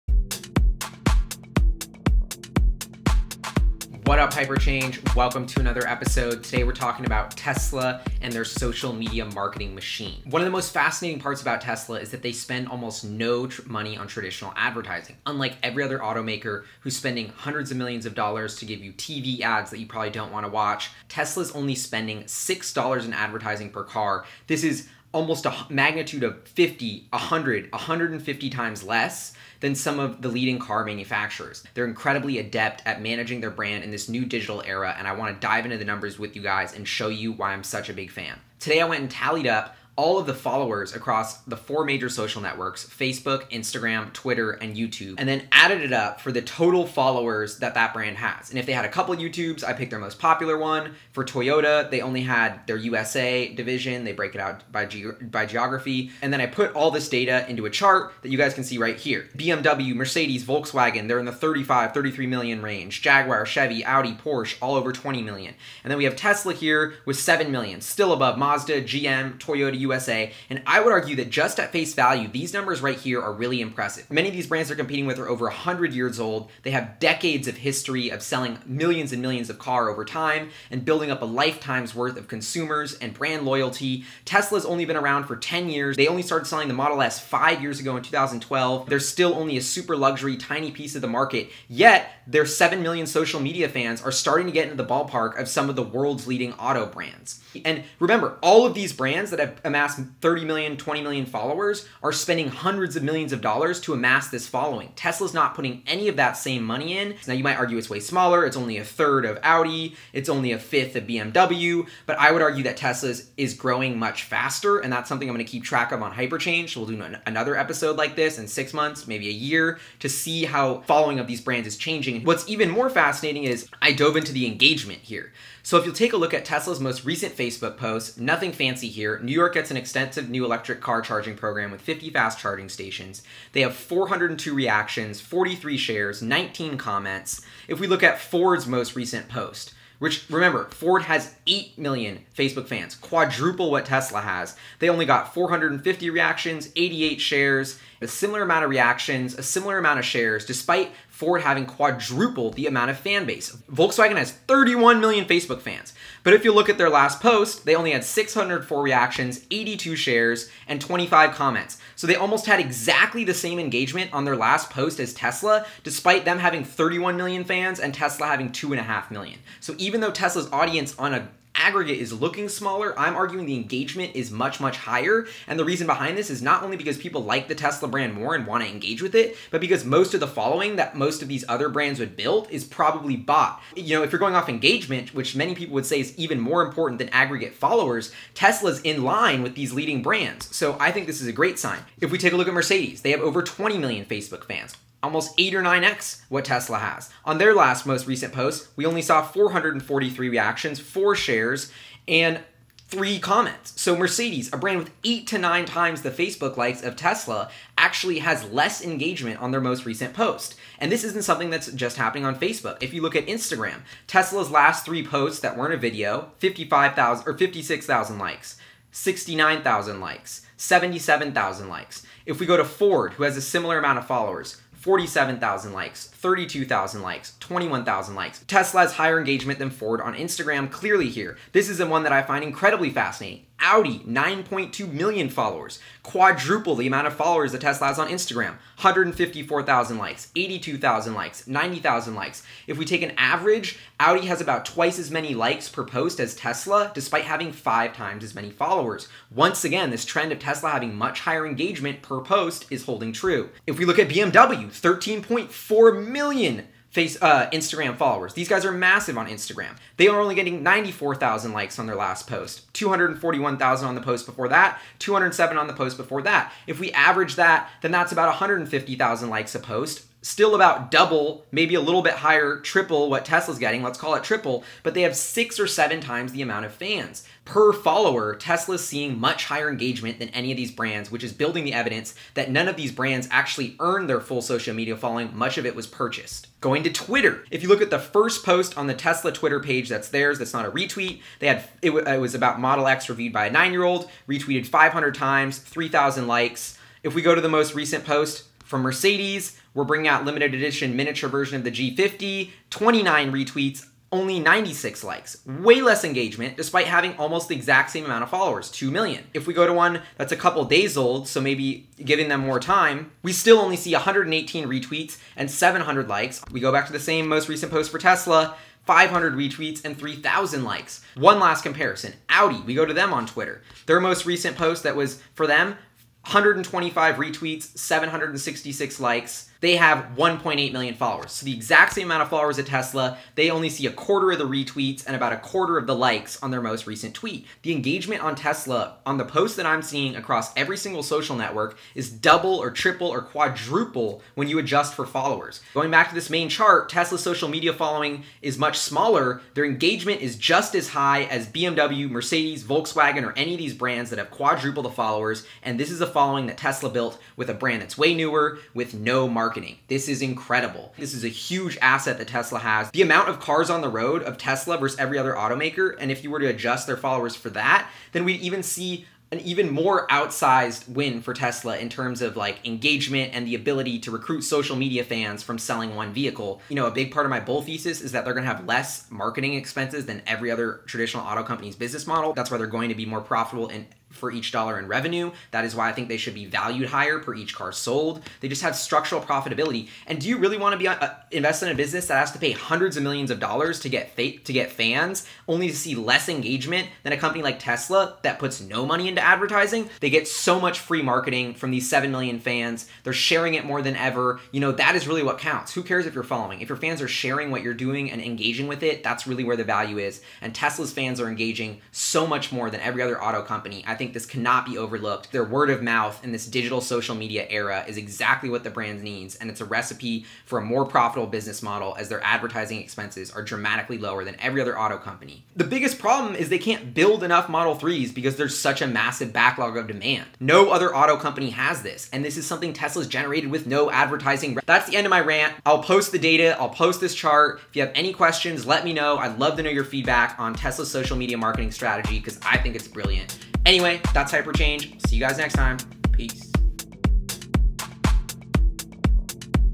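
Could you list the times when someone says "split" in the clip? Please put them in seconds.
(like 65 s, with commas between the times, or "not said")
not said.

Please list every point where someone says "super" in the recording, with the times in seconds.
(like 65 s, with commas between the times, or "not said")
89 s.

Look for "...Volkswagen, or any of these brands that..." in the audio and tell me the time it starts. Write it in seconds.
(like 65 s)
352 s.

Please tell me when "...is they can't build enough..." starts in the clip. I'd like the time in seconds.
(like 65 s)
426 s.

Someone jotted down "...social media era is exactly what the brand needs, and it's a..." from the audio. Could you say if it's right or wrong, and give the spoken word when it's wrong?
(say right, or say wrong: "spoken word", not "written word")
right.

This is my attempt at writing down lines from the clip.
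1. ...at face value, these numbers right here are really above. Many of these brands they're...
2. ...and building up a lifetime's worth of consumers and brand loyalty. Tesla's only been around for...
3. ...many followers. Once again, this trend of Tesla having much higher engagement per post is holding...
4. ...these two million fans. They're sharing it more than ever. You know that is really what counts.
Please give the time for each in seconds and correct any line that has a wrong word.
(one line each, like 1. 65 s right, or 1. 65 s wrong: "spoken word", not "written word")
1. 71 s wrong: "impressive", not "above"
2. 80 s right
3. 248 s right
4. 401 s wrong: "seven", not "two".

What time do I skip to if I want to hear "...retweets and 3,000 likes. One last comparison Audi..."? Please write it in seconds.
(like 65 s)
319 s.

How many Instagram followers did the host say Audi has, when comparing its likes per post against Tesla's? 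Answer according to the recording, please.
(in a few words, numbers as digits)
9.2 million.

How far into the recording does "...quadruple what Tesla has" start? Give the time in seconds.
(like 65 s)
142 s.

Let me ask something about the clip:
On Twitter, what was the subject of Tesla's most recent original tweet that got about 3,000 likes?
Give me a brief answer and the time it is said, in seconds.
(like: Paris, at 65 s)
Model X reviewed by a nine year old, at 292 s.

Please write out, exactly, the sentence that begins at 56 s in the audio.
And then I put all this data into a chart that you guys can see right here.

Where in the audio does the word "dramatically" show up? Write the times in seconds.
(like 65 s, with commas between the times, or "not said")
423 s.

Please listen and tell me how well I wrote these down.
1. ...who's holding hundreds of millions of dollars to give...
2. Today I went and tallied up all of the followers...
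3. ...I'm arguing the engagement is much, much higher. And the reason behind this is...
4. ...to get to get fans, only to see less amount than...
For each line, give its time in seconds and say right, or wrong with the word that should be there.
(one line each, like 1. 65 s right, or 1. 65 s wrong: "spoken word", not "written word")
1. 16 s wrong: "spending", not "holding"
2. 38 s right
3. 172 s right
4. 393 s wrong: "engagement", not "amount".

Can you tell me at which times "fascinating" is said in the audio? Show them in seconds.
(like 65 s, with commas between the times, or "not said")
10 s, 122 s, 232 s.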